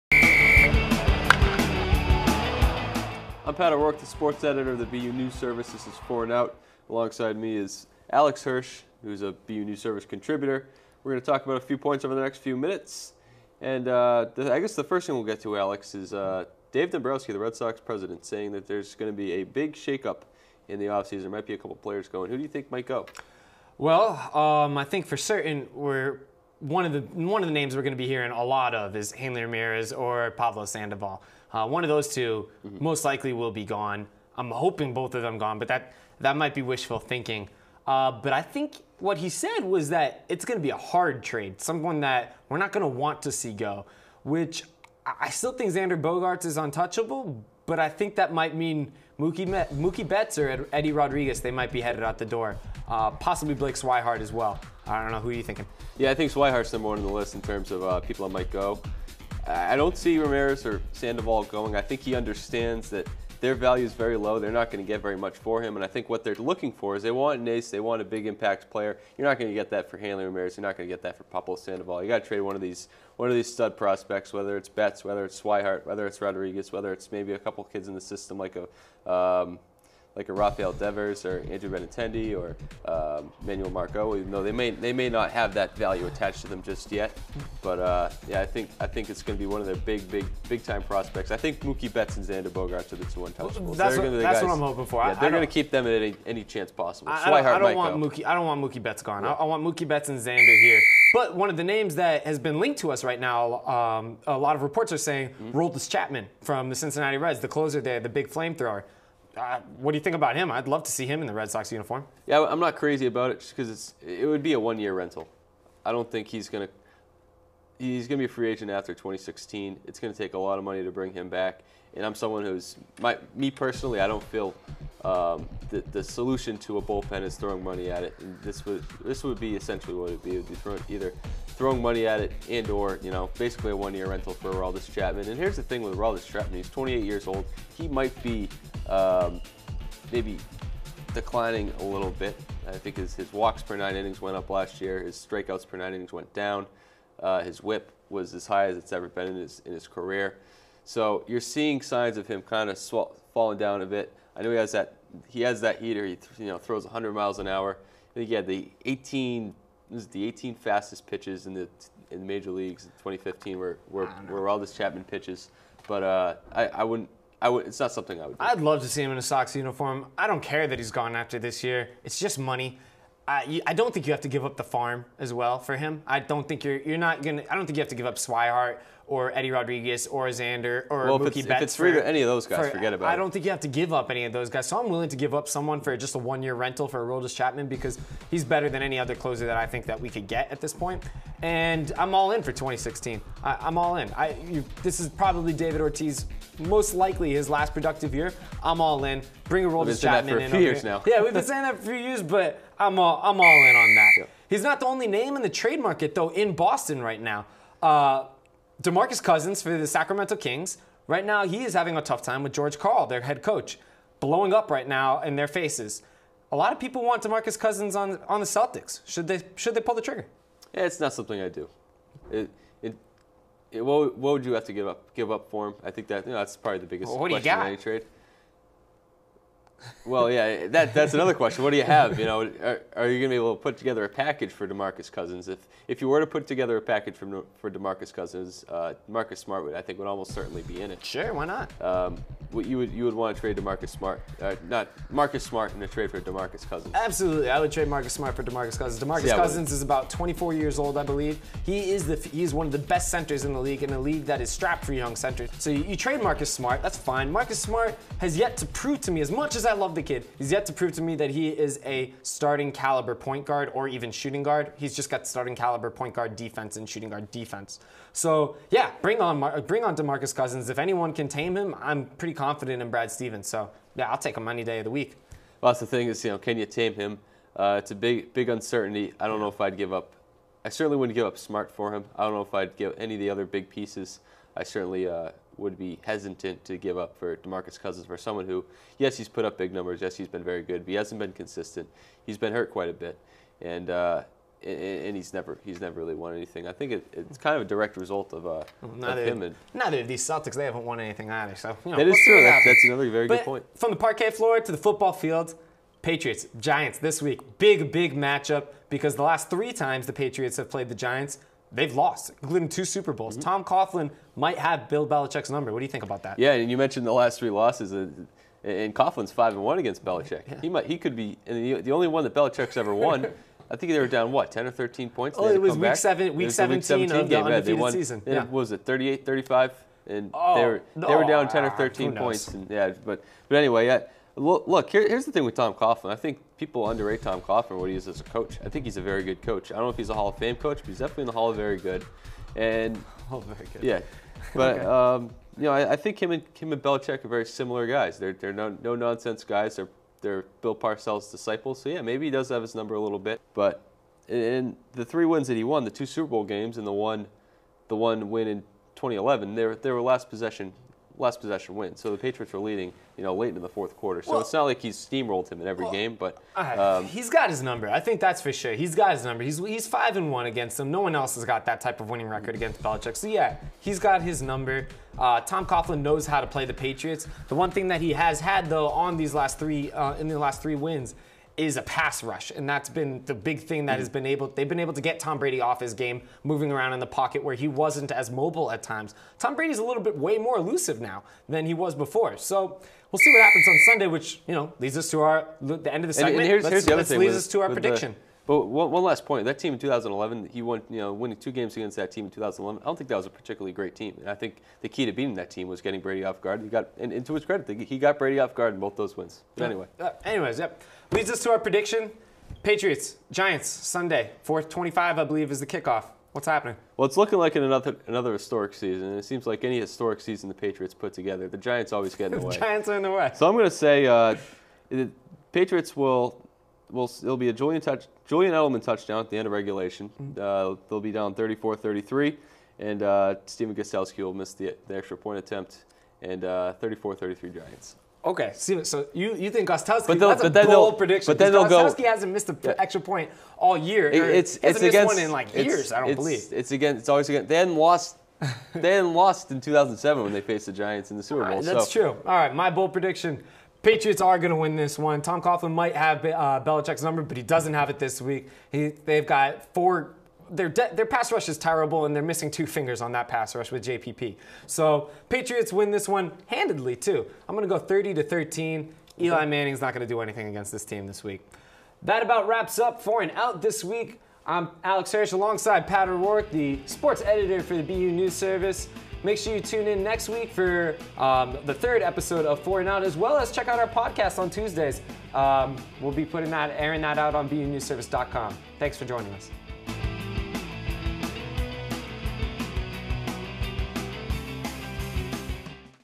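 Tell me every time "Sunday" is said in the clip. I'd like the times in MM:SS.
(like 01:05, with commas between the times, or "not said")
06:33, 06:53.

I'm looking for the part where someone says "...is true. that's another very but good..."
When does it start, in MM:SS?
05:02.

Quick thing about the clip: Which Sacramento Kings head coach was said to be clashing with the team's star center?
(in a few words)
George Karl.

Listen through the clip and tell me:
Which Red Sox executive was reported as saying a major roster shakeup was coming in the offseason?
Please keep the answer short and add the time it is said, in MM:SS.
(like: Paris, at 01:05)
Dave Dombrowski, at 00:16.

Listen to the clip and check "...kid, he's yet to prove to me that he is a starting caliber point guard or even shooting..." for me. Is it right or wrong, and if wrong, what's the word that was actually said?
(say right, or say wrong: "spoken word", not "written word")
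right.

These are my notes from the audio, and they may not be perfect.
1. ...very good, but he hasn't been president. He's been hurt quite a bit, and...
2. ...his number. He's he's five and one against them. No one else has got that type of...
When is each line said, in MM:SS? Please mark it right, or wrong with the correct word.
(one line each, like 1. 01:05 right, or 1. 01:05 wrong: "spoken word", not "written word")
1. 04:50 wrong: "consistent", not "president"
2. 06:09 right.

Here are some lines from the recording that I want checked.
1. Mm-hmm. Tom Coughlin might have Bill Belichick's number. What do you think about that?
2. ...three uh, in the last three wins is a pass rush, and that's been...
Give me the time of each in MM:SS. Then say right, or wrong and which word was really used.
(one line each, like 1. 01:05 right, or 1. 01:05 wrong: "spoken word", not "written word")
1. 05:13 right
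2. 06:19 right.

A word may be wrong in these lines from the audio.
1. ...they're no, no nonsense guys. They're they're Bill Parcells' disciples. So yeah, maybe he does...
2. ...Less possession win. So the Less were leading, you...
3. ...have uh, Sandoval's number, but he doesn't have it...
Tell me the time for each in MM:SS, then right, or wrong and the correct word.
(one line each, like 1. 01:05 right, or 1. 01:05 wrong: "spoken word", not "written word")
1. 05:48 right
2. 06:01 wrong: "Patriots", not "Less"
3. 07:35 wrong: "Belichick", not "Sandoval".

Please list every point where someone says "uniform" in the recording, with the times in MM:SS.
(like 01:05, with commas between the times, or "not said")
01:51, 02:49.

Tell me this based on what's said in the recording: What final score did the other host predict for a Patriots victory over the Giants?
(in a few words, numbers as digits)
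30 to 13.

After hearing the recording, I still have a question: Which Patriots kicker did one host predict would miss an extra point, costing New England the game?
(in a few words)
Stephen Gostkowski.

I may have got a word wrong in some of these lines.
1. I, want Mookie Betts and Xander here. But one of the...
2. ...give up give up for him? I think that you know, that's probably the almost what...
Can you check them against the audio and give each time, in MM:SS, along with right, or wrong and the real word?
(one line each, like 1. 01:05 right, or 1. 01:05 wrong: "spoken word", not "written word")
1. 01:39 right
2. 03:44 wrong: "biggest", not "almost".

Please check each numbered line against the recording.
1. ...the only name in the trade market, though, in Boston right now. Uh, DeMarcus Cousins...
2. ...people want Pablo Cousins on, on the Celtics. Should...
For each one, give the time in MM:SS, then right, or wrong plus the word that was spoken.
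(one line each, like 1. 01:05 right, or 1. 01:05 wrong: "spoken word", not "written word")
1. 03:24 right
2. 03:36 wrong: "DeMarcus", not "Pablo".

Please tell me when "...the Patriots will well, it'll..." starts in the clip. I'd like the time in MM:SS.
07:04.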